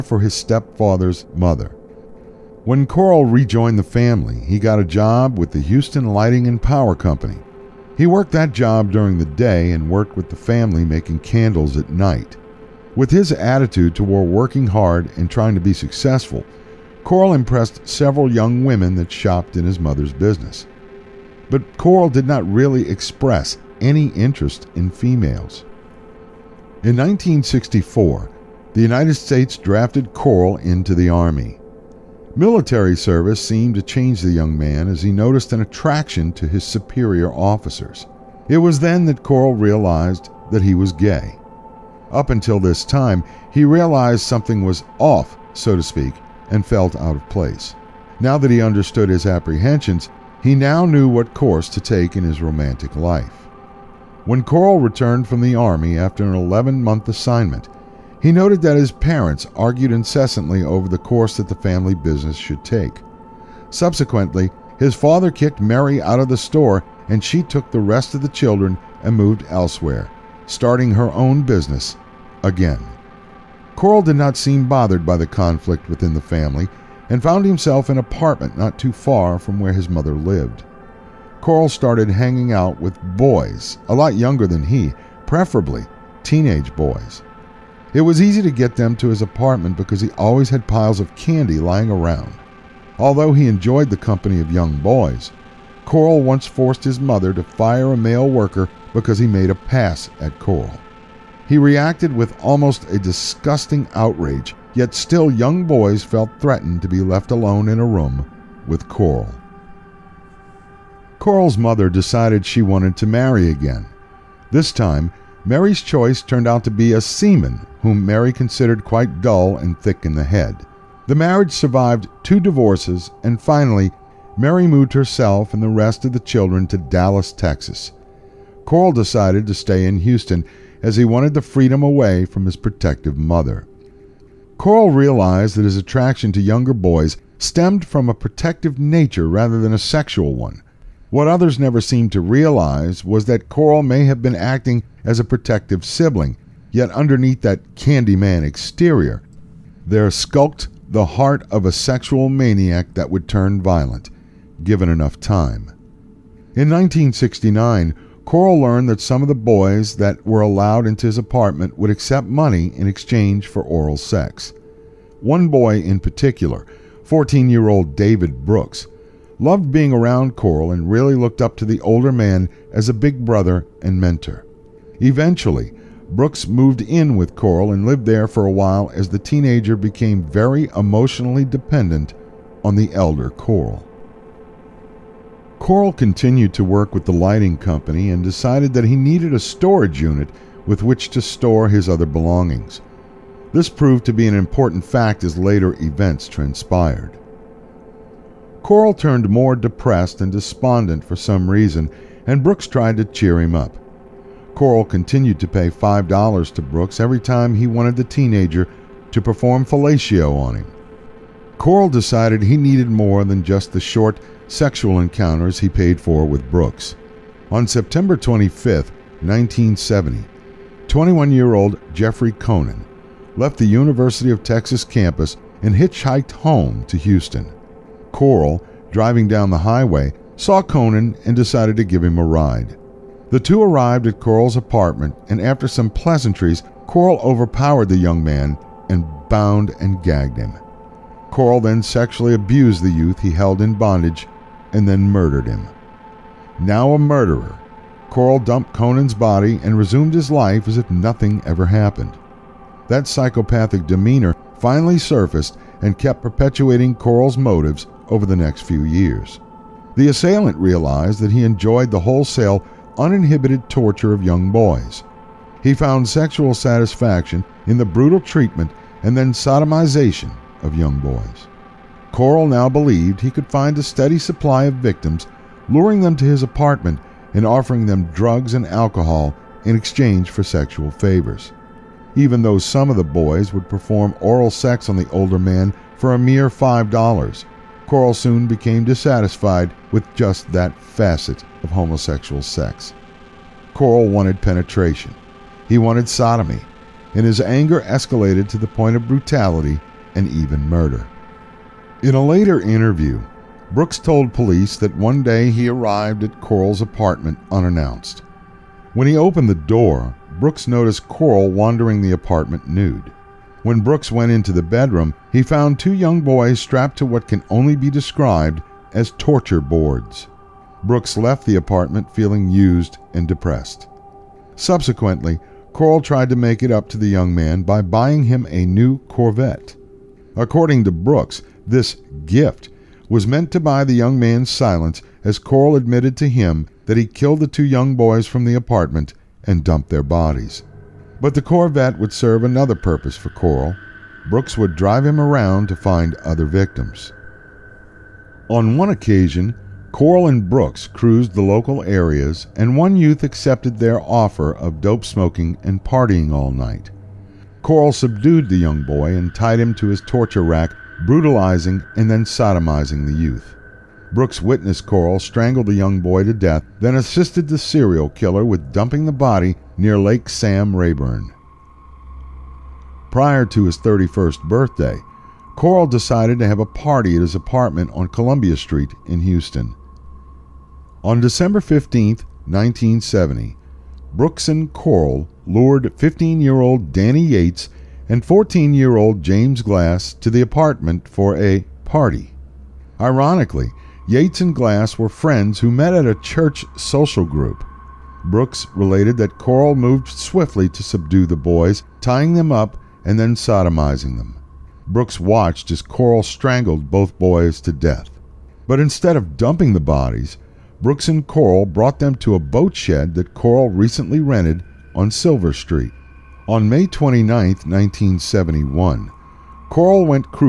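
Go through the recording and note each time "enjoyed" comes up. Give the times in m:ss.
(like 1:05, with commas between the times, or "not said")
1:33, 4:21.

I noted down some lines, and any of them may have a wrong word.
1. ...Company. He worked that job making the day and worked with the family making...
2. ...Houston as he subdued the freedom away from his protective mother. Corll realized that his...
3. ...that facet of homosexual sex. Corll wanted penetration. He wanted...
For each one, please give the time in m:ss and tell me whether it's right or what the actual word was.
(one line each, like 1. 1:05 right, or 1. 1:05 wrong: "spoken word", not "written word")
1. 0:06 wrong: "during", not "making"
2. 2:09 wrong: "wanted", not "subdued"
3. 4:50 right.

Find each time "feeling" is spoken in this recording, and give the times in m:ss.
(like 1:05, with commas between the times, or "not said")
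5:22.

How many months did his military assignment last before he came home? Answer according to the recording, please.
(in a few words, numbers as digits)
11.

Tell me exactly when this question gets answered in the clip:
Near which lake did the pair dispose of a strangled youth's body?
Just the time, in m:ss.
6:09.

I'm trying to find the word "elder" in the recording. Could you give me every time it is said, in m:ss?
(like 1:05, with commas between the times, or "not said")
3:02.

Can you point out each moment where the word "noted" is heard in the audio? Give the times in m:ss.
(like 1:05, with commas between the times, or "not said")
0:58.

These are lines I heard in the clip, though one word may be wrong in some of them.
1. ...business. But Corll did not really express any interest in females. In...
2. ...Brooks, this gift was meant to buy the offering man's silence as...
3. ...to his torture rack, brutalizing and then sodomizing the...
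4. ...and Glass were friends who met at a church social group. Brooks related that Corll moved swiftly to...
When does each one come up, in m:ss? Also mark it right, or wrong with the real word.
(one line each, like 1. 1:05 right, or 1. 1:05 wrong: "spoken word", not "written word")
1. 0:20 right
2. 5:30 wrong: "young", not "offering"
3. 5:59 right
4. 6:34 right.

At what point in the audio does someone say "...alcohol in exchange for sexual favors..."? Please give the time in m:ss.
4:38.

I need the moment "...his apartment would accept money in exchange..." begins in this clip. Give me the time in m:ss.
2:41.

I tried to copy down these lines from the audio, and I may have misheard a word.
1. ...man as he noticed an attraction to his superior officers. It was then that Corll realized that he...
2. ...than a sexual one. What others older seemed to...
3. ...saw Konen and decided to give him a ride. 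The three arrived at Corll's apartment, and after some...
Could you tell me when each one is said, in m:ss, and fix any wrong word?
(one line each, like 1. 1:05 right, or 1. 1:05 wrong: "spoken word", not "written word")
1. 0:34 right
2. 2:19 wrong: "never", not "older"
3. 3:50 wrong: "two", not "three".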